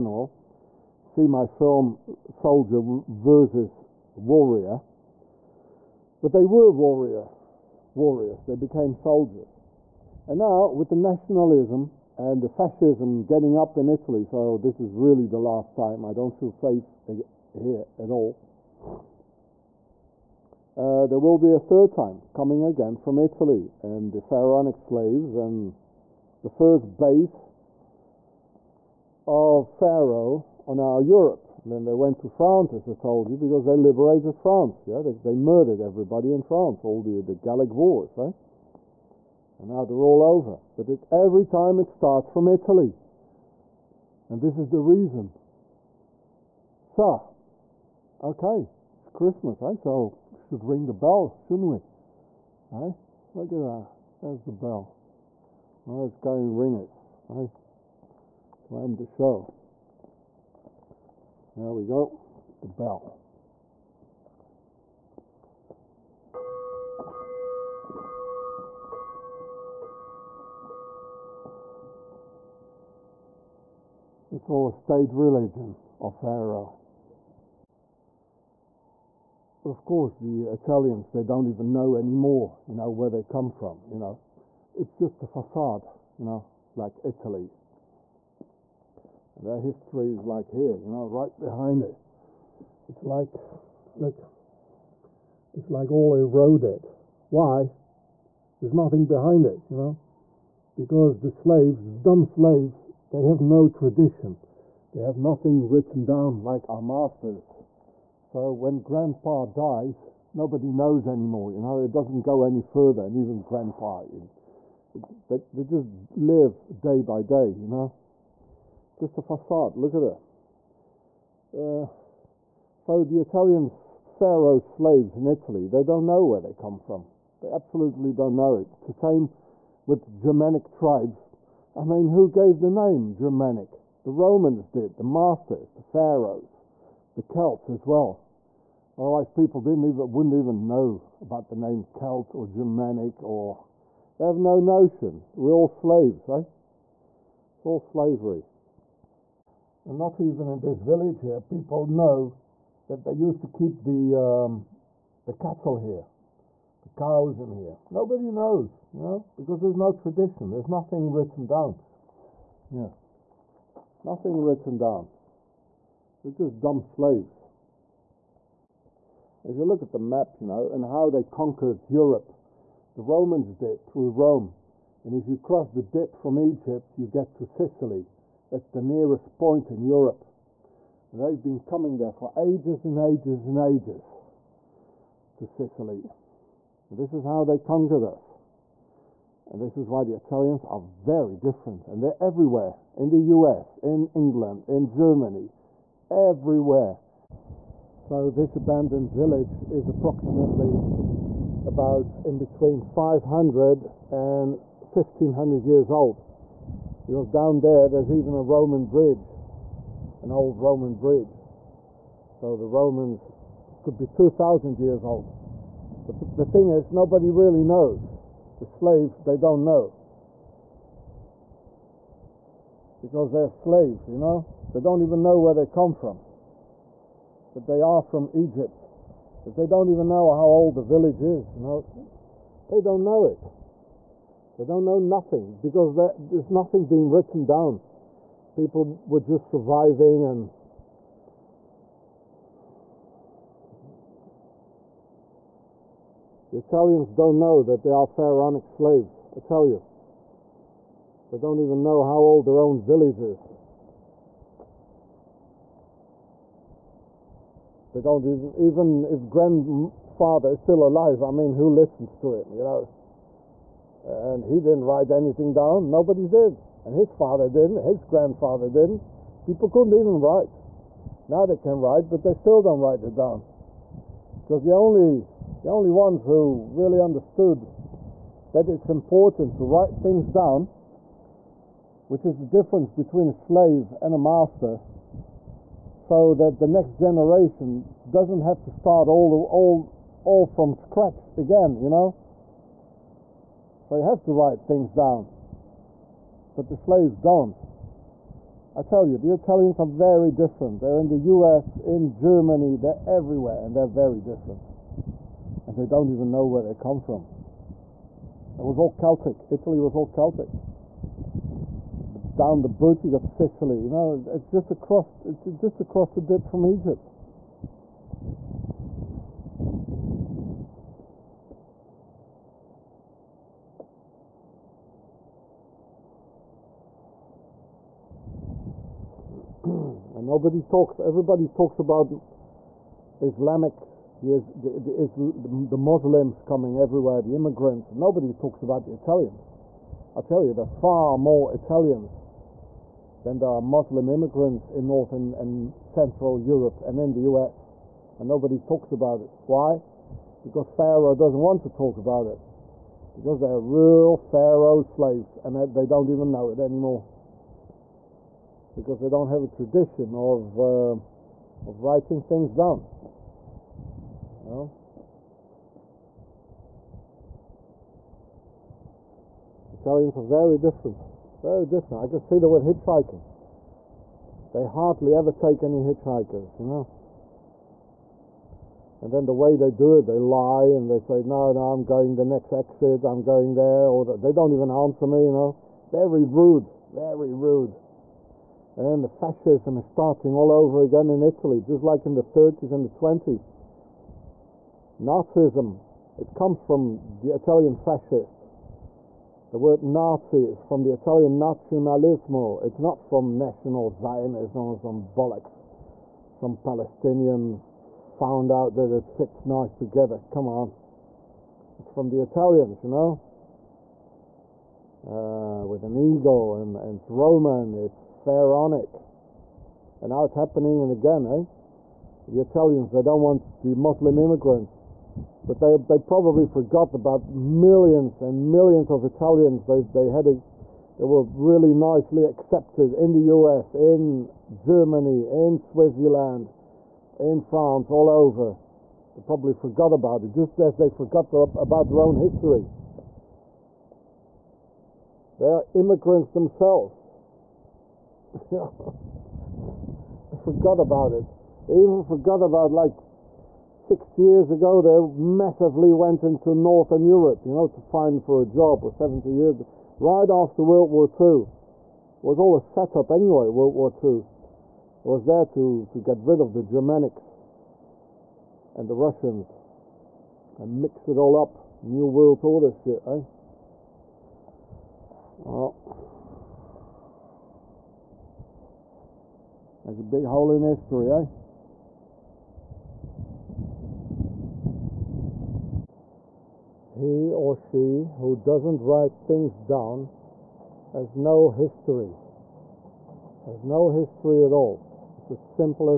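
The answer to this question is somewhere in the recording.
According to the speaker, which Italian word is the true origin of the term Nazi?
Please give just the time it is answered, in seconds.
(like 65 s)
401 s.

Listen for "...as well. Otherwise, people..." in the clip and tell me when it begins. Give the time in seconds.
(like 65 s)
137 s.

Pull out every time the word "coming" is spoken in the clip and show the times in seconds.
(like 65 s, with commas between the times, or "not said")
22 s, 181 s, 336 s.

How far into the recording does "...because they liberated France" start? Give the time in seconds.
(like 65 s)
33 s.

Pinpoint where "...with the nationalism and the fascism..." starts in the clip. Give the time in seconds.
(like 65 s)
10 s.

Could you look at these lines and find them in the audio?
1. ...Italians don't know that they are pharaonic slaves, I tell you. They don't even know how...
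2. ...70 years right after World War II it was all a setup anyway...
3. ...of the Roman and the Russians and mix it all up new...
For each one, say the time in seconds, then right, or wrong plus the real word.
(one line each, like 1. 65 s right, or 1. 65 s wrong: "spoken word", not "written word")
1. 246 s right
2. 458 s right
3. 466 s wrong: "Germanics", not "Roman".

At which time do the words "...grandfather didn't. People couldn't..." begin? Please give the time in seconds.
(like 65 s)
268 s.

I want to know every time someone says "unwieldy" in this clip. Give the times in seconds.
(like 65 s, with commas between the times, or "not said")
not said.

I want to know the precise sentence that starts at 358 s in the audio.
Because they don't have a tradition of, uh, of writing things down.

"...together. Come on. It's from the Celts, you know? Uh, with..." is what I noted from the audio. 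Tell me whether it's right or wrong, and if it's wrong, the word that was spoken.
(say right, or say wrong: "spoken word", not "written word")
wrong: "Italians", not "Celts".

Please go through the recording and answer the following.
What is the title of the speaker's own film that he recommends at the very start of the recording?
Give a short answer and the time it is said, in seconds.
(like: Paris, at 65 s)
Soldier versus Warrior, at 2 s.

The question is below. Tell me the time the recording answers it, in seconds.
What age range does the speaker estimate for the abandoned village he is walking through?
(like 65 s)
202 s.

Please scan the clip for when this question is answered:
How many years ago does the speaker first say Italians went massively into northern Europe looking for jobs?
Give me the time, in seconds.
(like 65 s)
453 s.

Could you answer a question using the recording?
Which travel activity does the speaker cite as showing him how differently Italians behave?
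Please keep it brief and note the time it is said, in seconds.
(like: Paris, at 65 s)
hitchhiking, at 372 s.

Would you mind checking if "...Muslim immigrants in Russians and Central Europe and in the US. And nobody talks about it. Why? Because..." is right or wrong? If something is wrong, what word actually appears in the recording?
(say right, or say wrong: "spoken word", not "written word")
wrong: "Northern", not "Russians".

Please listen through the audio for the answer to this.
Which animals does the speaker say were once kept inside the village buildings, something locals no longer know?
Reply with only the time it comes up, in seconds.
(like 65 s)
155 s.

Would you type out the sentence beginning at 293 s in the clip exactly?
So you have to write things down, but the slaves don't.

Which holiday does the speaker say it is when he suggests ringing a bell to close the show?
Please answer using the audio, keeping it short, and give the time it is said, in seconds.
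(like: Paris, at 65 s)
Christmas, at 49 s.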